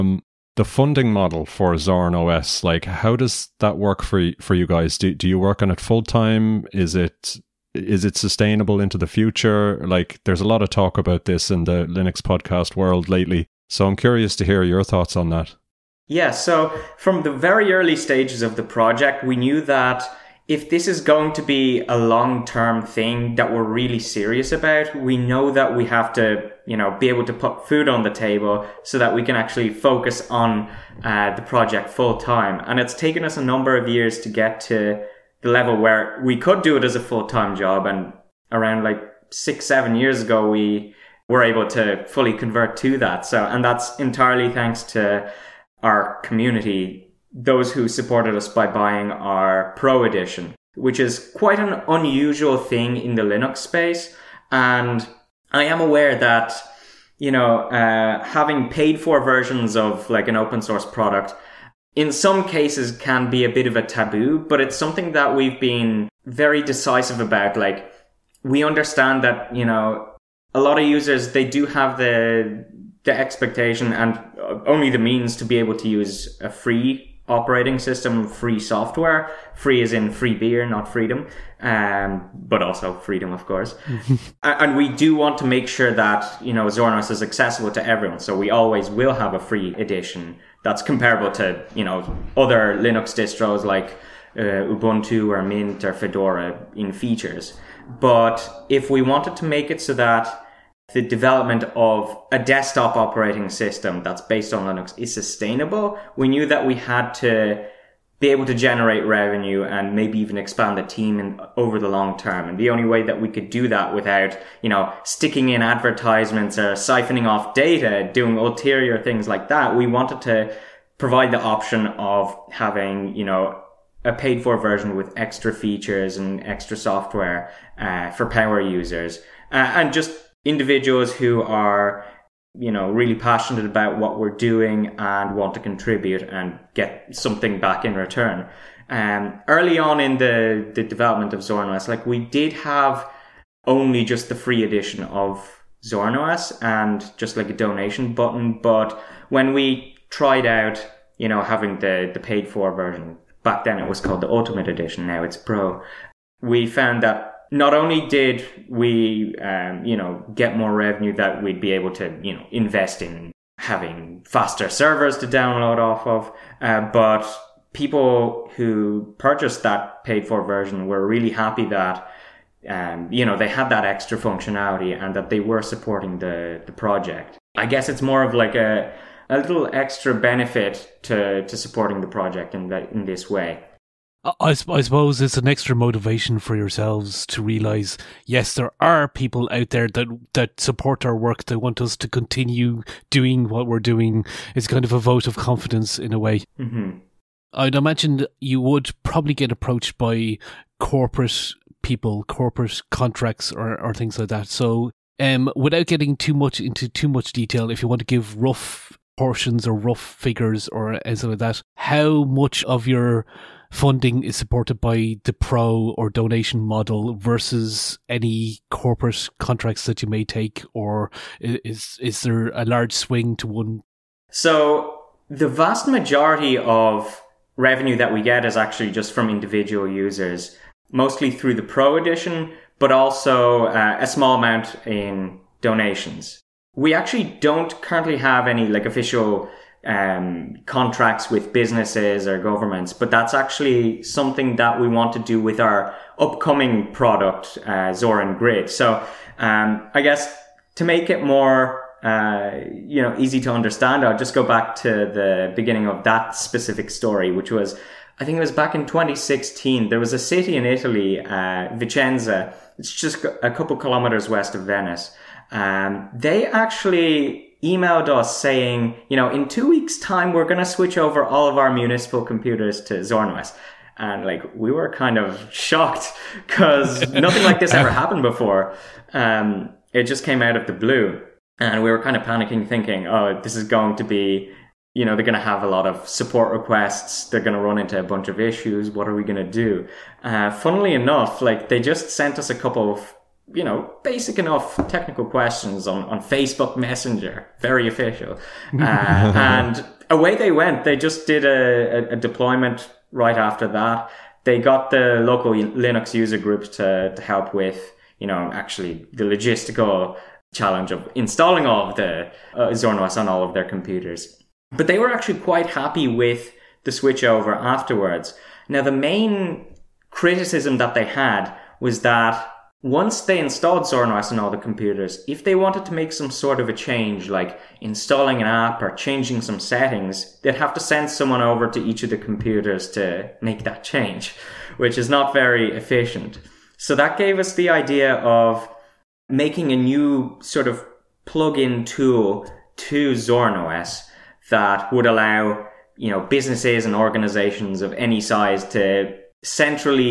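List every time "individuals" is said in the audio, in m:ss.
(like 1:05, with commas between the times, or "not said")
2:10, 3:49.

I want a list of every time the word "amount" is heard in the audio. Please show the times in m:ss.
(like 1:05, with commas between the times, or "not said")
3:54.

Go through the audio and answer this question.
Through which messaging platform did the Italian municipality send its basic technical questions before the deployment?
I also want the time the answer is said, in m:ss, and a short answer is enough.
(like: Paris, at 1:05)
Facebook Messenger, at 4:56.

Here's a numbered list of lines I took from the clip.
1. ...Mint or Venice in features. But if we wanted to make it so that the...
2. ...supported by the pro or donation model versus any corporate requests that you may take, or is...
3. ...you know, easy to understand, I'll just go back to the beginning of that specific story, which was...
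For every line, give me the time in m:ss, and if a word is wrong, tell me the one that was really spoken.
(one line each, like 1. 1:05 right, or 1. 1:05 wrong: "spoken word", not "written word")
1. 1:35 wrong: "Fedora", not "Venice"
2. 3:34 wrong: "contracts", not "requests"
3. 4:12 right.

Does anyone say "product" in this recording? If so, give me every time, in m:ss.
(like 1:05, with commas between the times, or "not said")
1:00, 4:06.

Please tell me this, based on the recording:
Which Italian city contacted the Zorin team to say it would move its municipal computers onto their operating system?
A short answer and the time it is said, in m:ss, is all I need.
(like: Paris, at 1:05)
Vicenza, at 4:21.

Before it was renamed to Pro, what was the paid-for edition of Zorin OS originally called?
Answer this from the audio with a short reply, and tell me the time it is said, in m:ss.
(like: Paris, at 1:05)
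Ultimate Edition, at 2:34.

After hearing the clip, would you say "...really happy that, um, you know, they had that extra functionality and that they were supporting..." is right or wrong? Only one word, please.
right.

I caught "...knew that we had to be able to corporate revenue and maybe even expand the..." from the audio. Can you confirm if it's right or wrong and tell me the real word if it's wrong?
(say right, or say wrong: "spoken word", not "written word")
wrong: "generate", not "corporate".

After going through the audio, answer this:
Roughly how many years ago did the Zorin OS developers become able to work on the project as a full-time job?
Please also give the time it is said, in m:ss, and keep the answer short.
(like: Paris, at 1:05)
6 or 7 years, at 0:39.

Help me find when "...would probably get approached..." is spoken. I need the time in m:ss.
3:18.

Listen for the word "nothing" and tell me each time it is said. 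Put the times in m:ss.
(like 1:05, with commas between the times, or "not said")
4:37.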